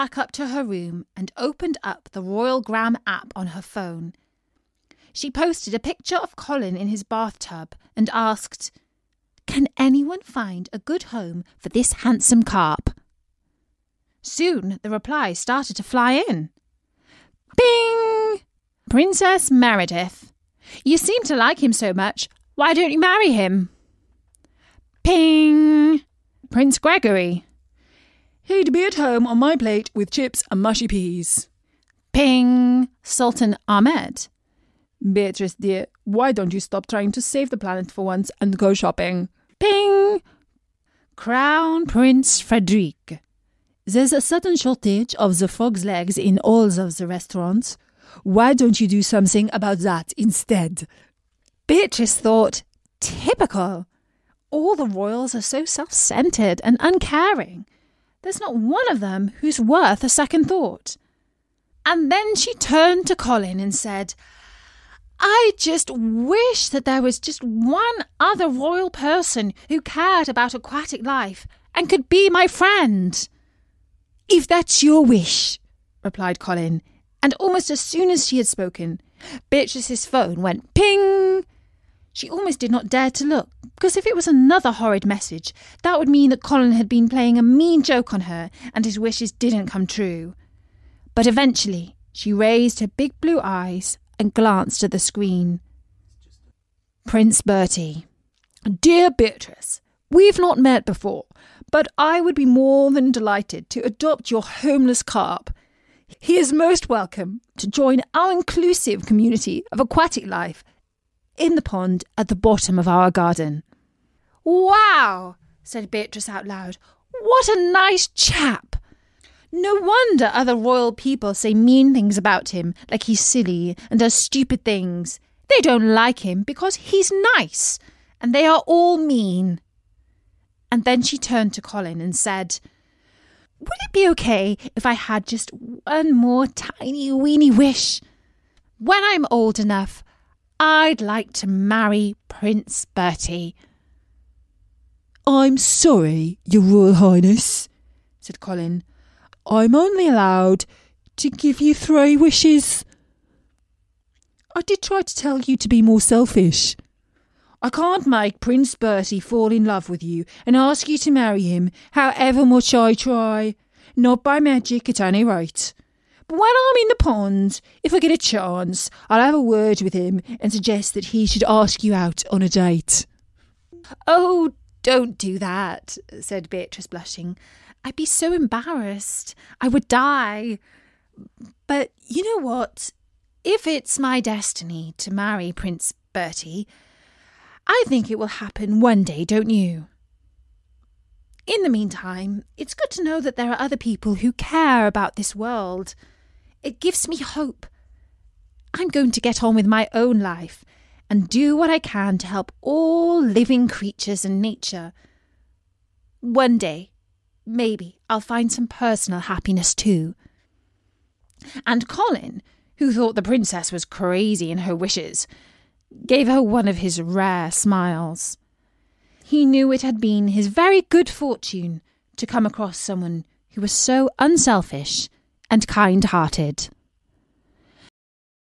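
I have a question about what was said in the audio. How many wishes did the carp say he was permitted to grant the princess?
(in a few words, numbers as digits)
3.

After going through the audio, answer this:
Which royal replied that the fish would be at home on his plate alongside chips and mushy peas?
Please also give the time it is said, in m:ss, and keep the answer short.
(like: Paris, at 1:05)
Prince Gregory, at 0:26.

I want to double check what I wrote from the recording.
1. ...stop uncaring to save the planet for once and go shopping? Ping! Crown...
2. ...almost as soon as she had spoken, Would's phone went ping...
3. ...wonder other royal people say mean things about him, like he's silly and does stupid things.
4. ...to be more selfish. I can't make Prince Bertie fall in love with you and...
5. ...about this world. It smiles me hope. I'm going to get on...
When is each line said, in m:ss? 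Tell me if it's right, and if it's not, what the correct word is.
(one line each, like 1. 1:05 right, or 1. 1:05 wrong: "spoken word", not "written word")
1. 0:36 wrong: "trying", not "uncaring"
2. 1:17 wrong: "Beatrice", not "Would"
3. 1:59 right
4. 2:35 right
5. 3:14 wrong: "gives", not "smiles".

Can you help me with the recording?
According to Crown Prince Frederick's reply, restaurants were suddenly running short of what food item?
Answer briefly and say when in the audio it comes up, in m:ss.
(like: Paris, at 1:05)
frog's legs, at 0:45.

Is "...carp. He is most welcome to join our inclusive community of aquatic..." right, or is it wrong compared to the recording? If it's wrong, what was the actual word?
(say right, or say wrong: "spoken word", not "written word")
right.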